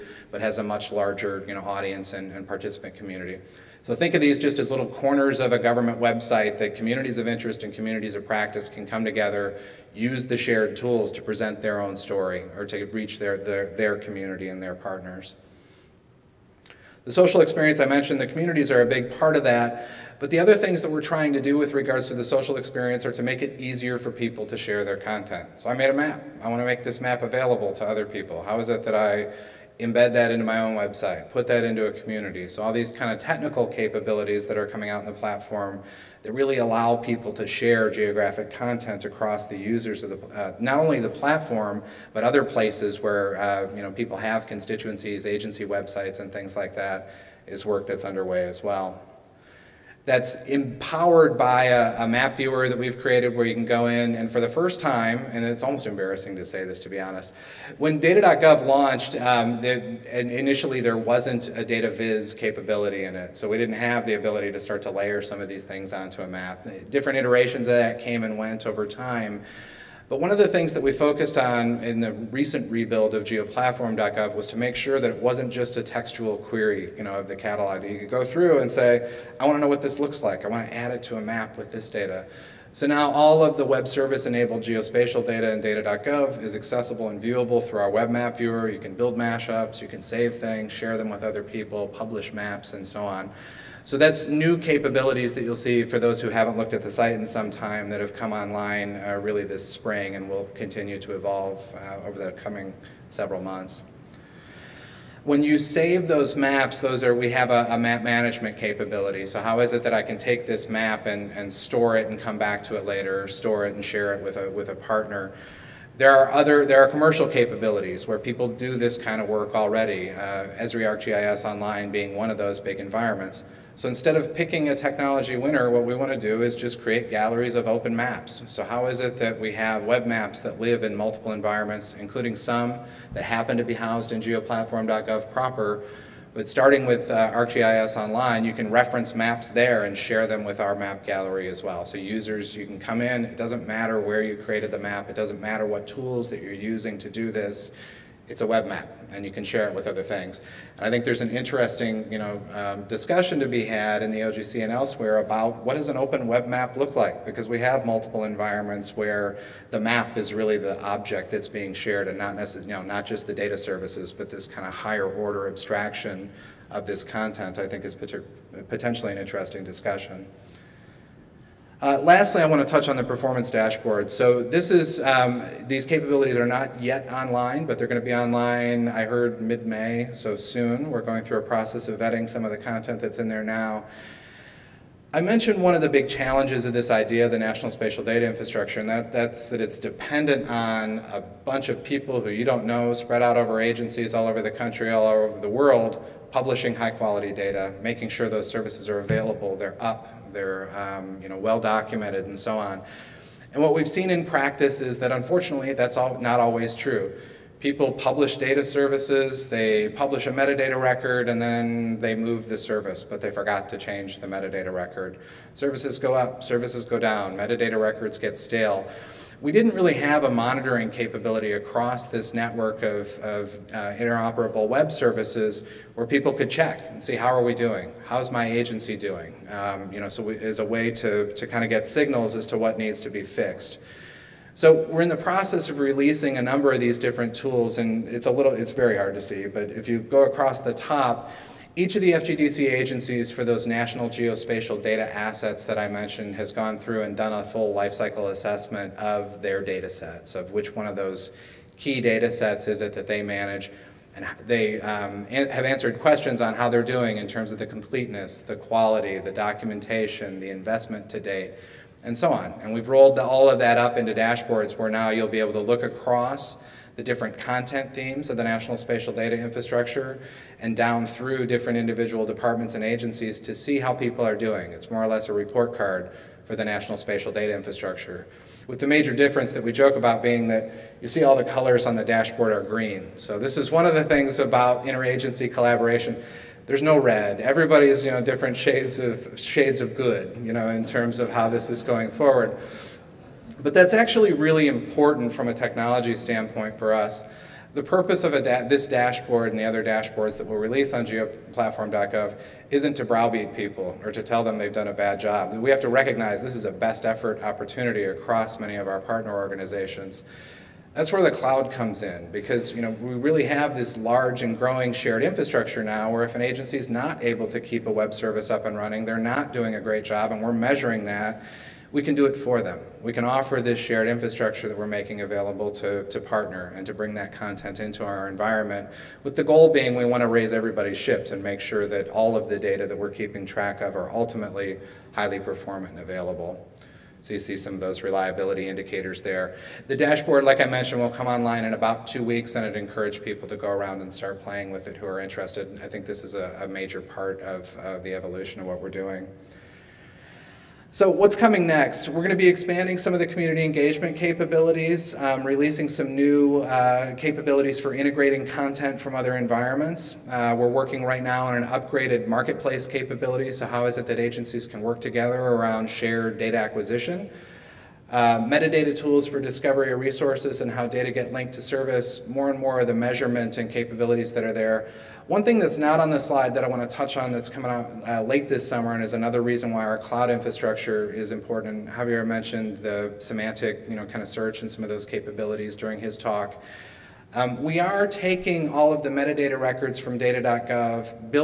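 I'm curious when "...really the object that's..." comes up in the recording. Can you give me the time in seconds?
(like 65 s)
160 s.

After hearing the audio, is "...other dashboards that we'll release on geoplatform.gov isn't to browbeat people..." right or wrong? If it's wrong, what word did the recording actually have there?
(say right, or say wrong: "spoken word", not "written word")
right.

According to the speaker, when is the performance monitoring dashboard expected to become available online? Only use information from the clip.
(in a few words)
mid-May.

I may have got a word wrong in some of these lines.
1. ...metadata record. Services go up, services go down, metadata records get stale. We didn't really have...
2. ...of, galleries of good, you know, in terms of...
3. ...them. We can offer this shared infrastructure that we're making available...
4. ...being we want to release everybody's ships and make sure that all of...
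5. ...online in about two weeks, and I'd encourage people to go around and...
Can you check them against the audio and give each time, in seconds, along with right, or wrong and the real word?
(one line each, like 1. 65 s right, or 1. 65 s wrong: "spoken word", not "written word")
1. 214 s right
2. 288 s wrong: "shades", not "galleries"
3. 322 s right
4. 329 s wrong: "raise", not "release"
5. 341 s right.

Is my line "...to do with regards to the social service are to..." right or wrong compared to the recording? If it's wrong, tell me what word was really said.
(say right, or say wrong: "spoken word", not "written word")
wrong: "experience", not "service".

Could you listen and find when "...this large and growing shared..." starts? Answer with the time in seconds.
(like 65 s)
313 s.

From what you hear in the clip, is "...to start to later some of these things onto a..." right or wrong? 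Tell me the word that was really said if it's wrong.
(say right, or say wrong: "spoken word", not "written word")
wrong: "layer", not "later".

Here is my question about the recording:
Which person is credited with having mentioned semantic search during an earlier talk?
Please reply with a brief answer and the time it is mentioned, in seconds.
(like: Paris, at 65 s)
Javier, at 381 s.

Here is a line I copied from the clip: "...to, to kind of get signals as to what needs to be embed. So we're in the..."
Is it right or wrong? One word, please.
wrong.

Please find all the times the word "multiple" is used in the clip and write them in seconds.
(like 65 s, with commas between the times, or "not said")
130 s, 157 s.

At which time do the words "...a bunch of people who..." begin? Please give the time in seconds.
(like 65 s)
191 s.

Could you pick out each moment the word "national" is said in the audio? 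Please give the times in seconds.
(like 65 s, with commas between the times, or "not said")
187 s, 243 s, 268 s, 276 s.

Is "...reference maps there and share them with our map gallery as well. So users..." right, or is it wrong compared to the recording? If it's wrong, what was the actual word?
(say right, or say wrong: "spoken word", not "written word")
right.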